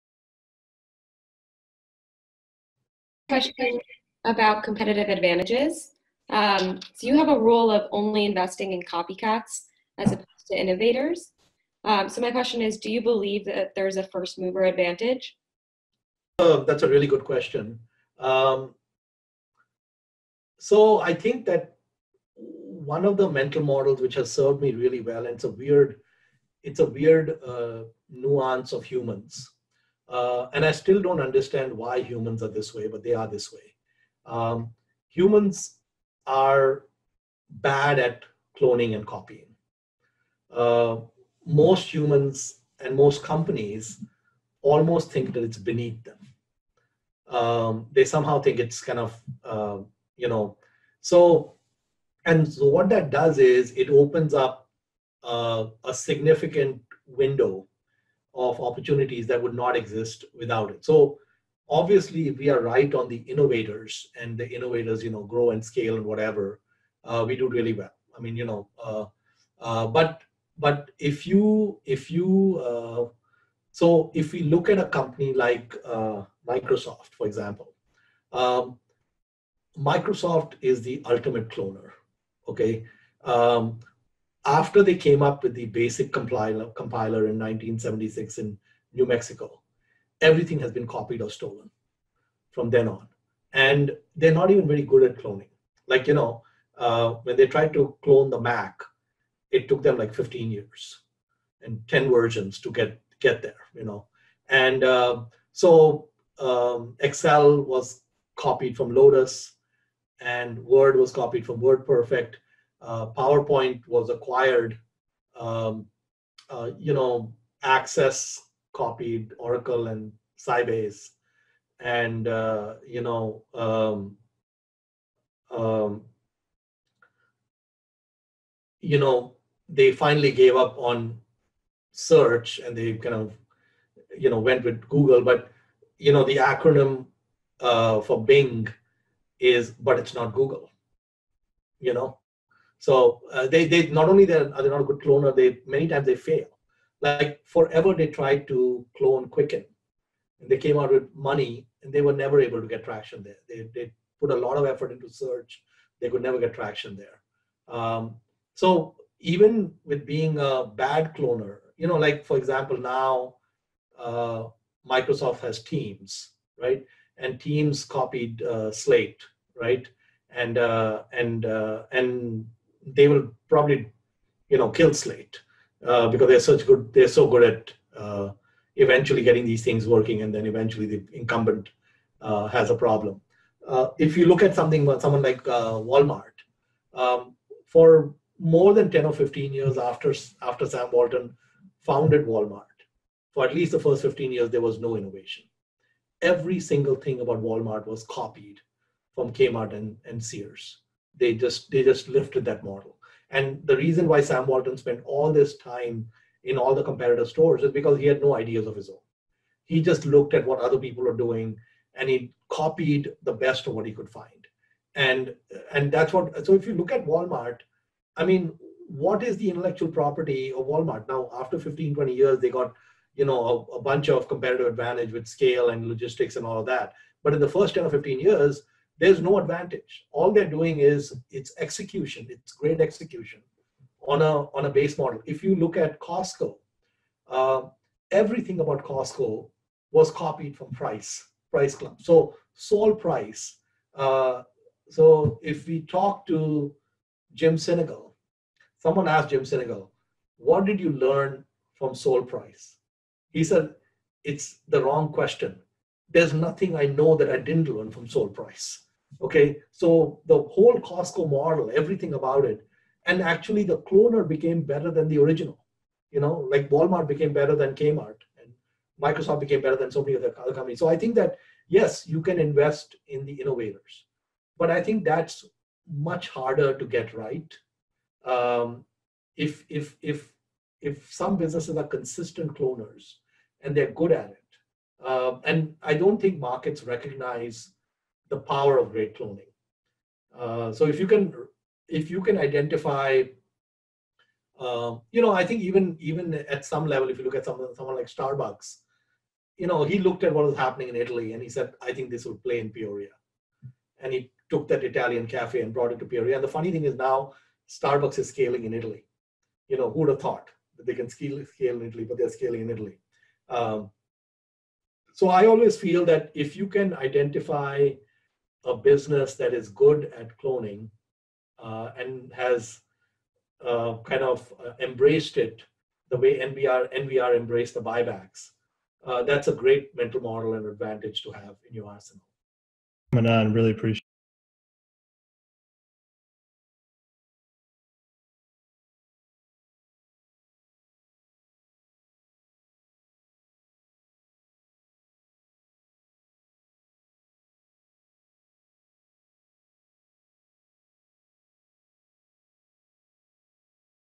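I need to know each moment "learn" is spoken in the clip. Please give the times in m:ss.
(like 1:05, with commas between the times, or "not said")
4:10, 4:17.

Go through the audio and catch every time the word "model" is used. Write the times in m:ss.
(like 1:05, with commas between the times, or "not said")
0:23, 3:22, 3:54, 4:21, 5:30.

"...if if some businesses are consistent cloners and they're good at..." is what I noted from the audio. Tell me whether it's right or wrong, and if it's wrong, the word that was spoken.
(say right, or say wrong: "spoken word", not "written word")
right.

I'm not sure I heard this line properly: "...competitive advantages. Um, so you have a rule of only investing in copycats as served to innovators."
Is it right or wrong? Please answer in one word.
wrong.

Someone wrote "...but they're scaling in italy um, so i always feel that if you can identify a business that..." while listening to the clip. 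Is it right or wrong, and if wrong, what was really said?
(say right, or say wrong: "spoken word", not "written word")
right.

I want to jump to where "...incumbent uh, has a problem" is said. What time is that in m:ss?
3:01.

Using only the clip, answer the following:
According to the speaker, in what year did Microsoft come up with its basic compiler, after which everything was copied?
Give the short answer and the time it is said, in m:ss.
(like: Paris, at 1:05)
1976, at 1:27.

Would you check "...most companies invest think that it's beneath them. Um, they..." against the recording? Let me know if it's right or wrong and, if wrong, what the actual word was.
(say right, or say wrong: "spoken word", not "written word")
wrong: "almost", not "invest".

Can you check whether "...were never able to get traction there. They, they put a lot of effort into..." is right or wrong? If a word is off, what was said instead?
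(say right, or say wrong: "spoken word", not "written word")
right.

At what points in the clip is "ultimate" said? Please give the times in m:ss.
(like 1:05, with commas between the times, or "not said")
1:21.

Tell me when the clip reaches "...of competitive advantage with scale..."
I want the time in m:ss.
3:44.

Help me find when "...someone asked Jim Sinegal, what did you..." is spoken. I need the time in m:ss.
4:08.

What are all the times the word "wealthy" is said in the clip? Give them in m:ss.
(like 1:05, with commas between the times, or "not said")
not said.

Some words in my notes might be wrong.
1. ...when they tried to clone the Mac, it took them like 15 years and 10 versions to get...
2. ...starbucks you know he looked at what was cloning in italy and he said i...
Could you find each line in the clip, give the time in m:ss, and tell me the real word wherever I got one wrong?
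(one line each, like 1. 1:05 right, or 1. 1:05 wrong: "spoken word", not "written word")
1. 1:37 right
2. 4:58 wrong: "happening", not "cloning".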